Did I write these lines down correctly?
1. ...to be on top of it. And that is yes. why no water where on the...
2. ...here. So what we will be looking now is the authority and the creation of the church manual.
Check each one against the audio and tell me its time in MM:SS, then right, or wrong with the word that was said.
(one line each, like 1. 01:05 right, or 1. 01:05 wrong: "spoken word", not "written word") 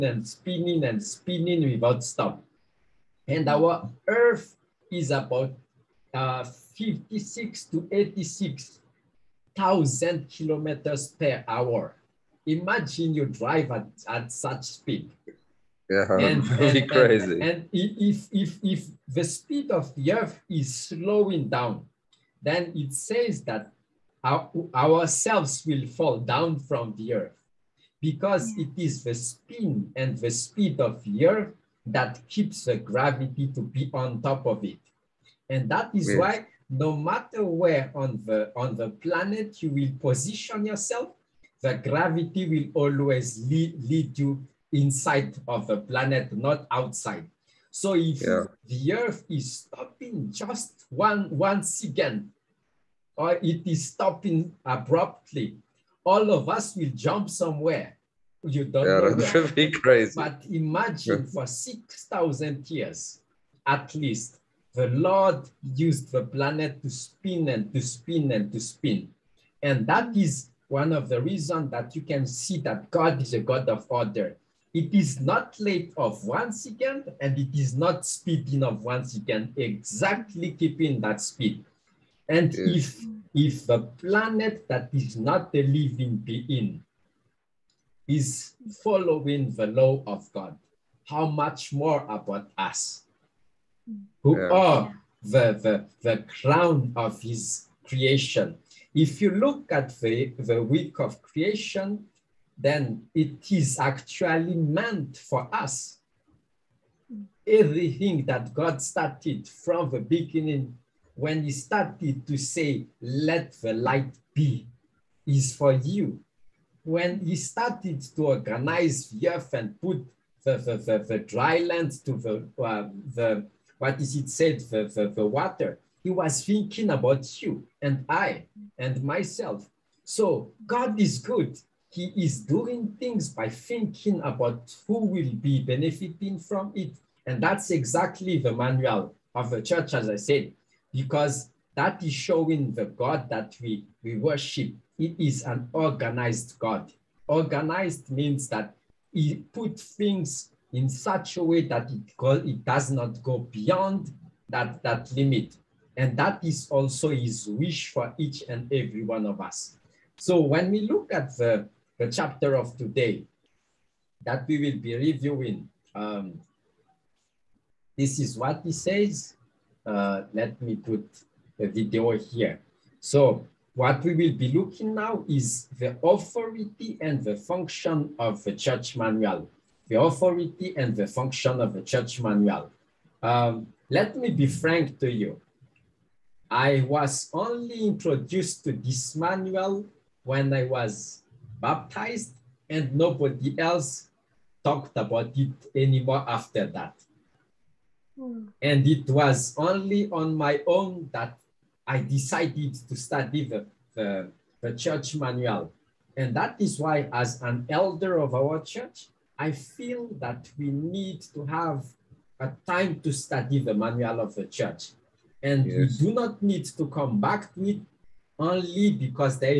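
1. 00:33 wrong: "matter", not "water"
2. 02:52 wrong: "function", not "creation".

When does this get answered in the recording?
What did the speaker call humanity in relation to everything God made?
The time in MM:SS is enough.
01:36.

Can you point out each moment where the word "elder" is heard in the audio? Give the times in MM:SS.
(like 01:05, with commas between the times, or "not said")
03:27.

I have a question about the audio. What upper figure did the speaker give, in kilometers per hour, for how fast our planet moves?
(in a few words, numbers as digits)
86,000.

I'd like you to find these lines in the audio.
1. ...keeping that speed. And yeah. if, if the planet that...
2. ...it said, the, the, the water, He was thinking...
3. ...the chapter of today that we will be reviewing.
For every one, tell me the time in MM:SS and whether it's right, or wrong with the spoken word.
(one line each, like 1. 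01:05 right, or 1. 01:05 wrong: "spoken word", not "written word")
1. 01:20 right
2. 02:04 right
3. 02:42 right.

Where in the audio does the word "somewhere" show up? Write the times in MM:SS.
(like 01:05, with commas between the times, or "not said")
00:57.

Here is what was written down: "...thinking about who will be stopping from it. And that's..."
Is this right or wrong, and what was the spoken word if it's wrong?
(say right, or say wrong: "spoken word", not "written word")
wrong: "benefiting", not "stopping".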